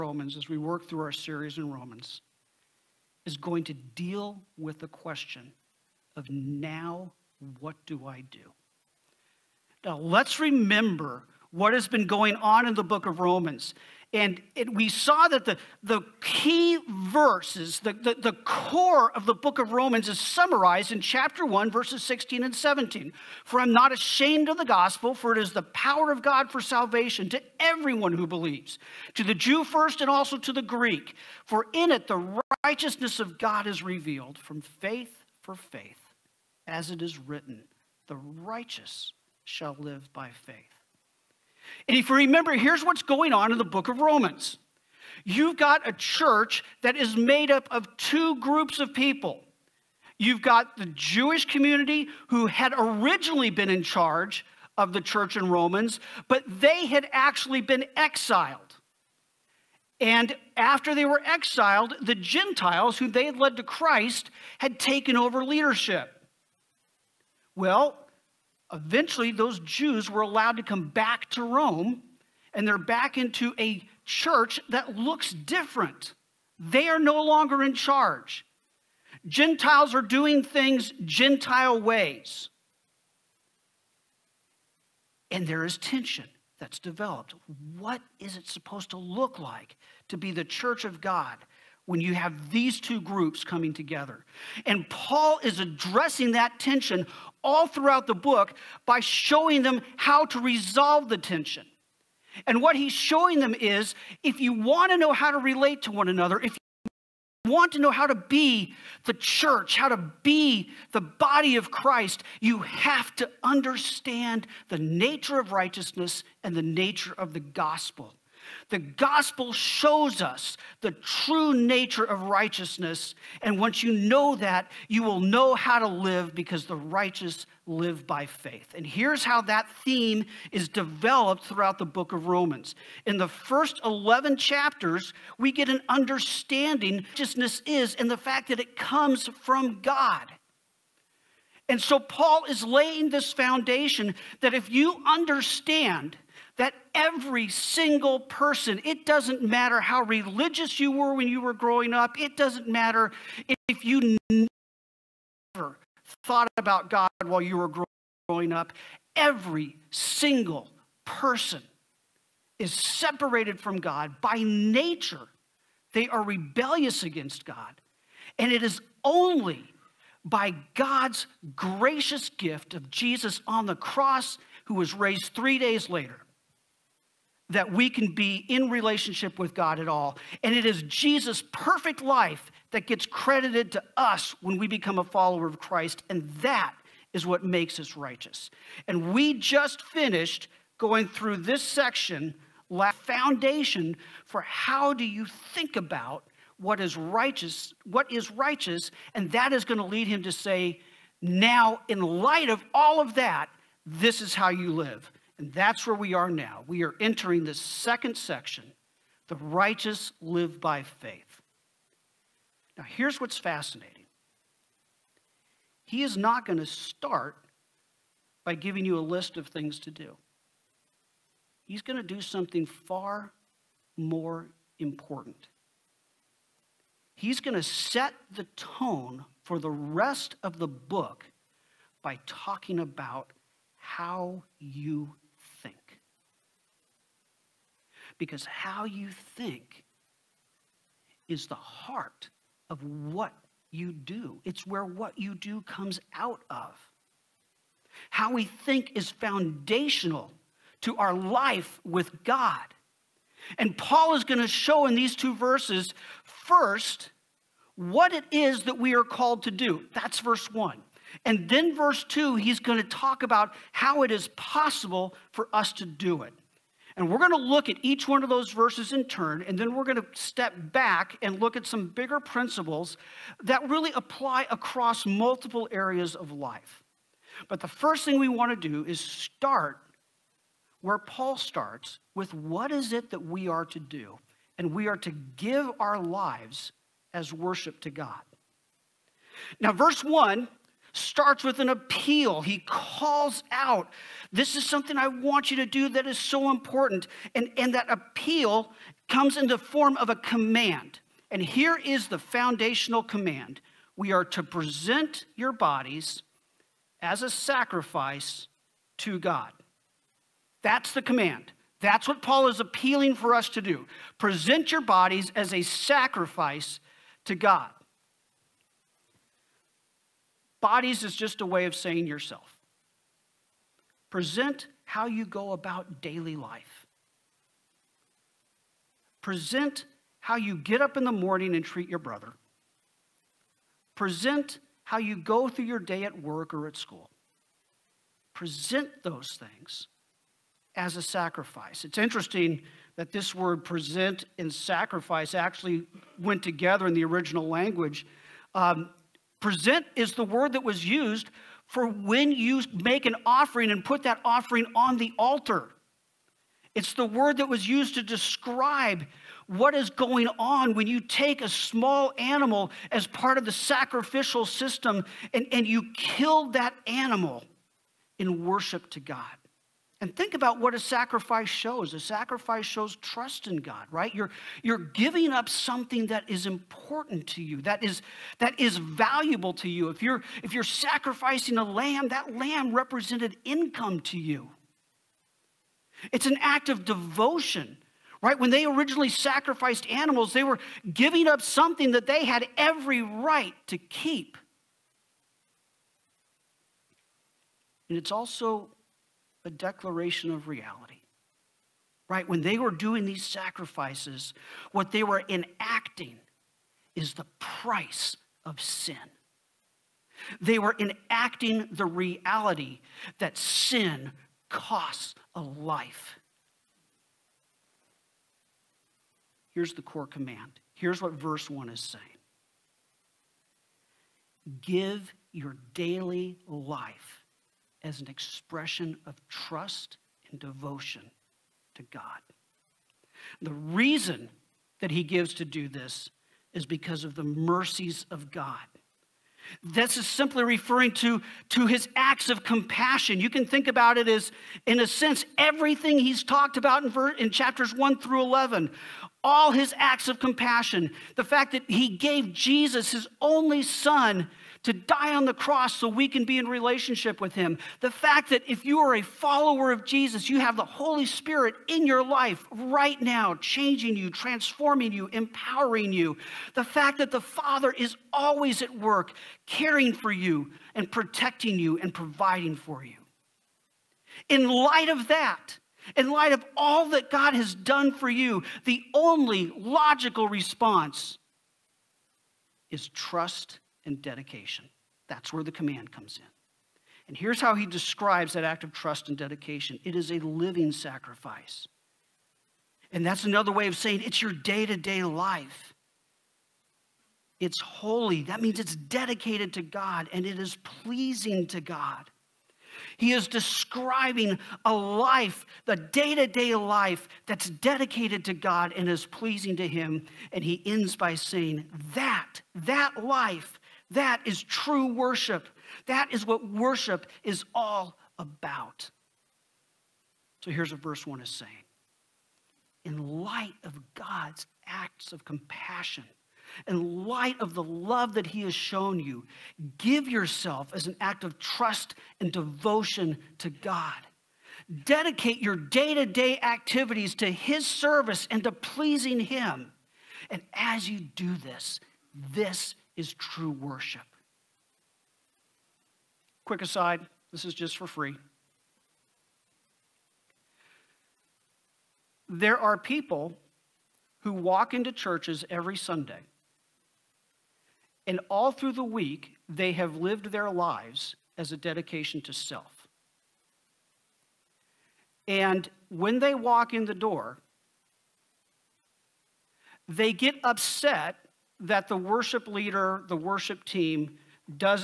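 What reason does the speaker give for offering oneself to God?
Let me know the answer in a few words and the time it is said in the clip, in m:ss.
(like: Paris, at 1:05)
the mercies of God, at 7:17.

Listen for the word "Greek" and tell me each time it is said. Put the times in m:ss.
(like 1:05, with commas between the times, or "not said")
0:30.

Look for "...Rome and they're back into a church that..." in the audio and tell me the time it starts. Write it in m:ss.
1:11.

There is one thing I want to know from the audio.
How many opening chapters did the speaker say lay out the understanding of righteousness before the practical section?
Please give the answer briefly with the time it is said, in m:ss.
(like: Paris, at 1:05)
11, at 2:13.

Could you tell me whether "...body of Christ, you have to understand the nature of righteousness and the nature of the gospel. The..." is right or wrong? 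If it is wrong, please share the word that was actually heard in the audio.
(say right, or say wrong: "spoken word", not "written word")
right.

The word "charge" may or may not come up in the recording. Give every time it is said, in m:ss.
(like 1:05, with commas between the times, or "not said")
0:53, 1:17.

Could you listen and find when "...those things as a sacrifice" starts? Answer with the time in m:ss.
5:39.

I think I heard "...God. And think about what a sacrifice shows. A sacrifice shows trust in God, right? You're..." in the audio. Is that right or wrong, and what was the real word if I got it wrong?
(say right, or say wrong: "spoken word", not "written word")
right.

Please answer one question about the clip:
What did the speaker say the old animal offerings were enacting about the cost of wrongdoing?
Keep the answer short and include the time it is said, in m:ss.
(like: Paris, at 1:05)
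sin costs a life, at 6:53.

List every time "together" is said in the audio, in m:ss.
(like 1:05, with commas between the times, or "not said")
1:33, 5:46.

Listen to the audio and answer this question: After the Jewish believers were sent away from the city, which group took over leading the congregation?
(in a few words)
the Gentiles.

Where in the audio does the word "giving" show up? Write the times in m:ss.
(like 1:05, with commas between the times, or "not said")
3:38, 6:14, 6:30.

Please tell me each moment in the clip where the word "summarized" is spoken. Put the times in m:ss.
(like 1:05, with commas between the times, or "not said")
0:20.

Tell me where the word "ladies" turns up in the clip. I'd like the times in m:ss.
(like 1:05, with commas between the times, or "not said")
not said.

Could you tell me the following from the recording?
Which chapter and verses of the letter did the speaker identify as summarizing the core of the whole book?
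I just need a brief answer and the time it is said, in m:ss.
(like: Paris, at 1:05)
chapter 1, verses 16 and 17, at 0:20.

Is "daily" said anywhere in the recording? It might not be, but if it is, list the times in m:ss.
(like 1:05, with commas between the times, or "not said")
5:26, 7:05.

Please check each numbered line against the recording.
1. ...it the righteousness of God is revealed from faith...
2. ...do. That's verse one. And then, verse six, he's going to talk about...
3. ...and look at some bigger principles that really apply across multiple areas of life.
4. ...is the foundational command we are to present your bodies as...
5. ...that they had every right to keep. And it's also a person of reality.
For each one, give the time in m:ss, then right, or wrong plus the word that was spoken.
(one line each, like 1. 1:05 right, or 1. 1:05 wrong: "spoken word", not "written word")
1. 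0:31 right
2. 4:19 wrong: "two", not "six"
3. 4:31 right
4. 5:01 right
5. 6:31 wrong: "declaration", not "person".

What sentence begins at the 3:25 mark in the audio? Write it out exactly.
And that's where we are now.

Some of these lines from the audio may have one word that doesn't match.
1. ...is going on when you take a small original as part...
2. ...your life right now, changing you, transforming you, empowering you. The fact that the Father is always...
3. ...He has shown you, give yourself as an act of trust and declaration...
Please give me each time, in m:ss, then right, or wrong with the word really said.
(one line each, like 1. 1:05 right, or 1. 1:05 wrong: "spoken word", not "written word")
1. 5:59 wrong: "animal", not "original"
2. 7:41 right
3. 8:48 wrong: "devotion", not "declaration".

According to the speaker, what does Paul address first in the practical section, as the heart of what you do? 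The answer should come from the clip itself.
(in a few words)
how you think.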